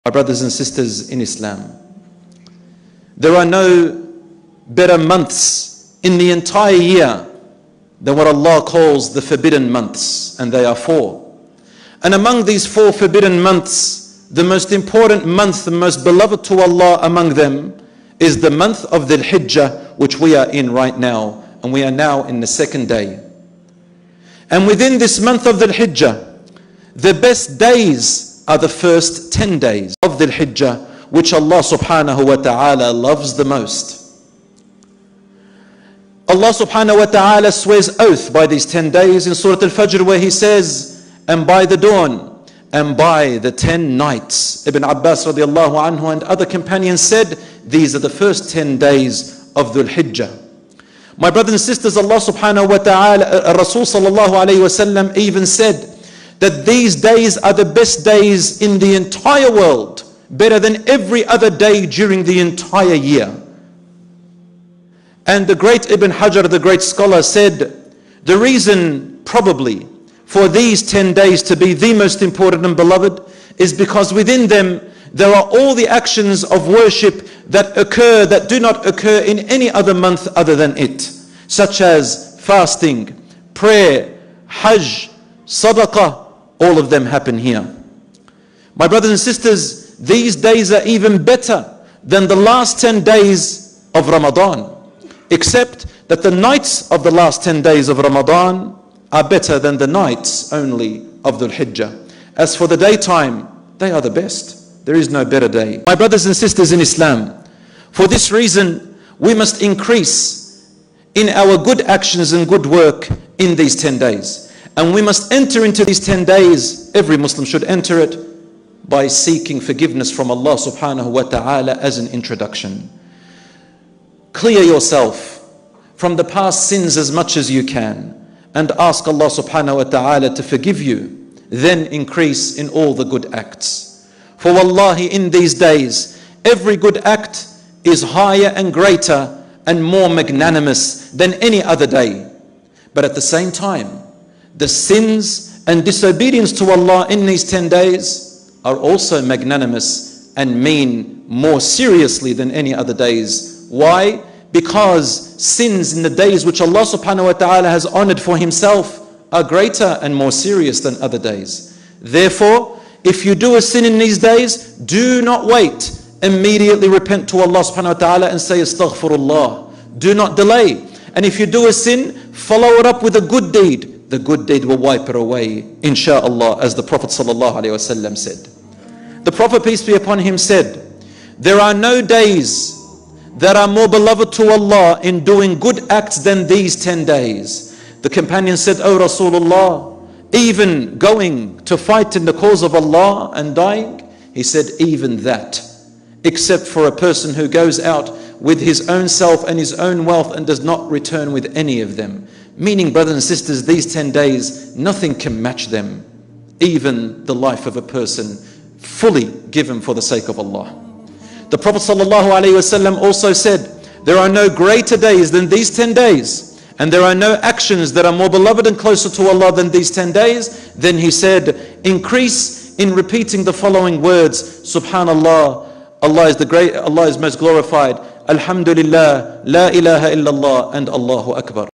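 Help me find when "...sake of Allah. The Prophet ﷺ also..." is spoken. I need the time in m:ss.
3:30.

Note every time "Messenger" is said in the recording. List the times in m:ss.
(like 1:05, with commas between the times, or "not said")
not said.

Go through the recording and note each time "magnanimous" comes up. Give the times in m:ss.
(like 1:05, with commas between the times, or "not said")
2:20, 2:29.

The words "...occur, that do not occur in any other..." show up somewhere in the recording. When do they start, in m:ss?
1:17.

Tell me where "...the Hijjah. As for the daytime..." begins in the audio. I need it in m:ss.
1:41.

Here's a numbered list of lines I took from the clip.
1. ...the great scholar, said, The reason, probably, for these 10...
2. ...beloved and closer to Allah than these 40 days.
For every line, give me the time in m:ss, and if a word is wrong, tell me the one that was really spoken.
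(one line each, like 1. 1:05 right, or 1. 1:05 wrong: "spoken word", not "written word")
1. 1:06 right
2. 3:38 wrong: "10", not "40".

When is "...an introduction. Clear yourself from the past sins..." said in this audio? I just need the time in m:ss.
2:01.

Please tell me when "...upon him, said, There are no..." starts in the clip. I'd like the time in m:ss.
2:59.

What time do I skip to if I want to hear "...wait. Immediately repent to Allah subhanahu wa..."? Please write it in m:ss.
2:45.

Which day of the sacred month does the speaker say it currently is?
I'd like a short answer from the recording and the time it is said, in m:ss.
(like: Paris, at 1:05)
second day, at 0:22.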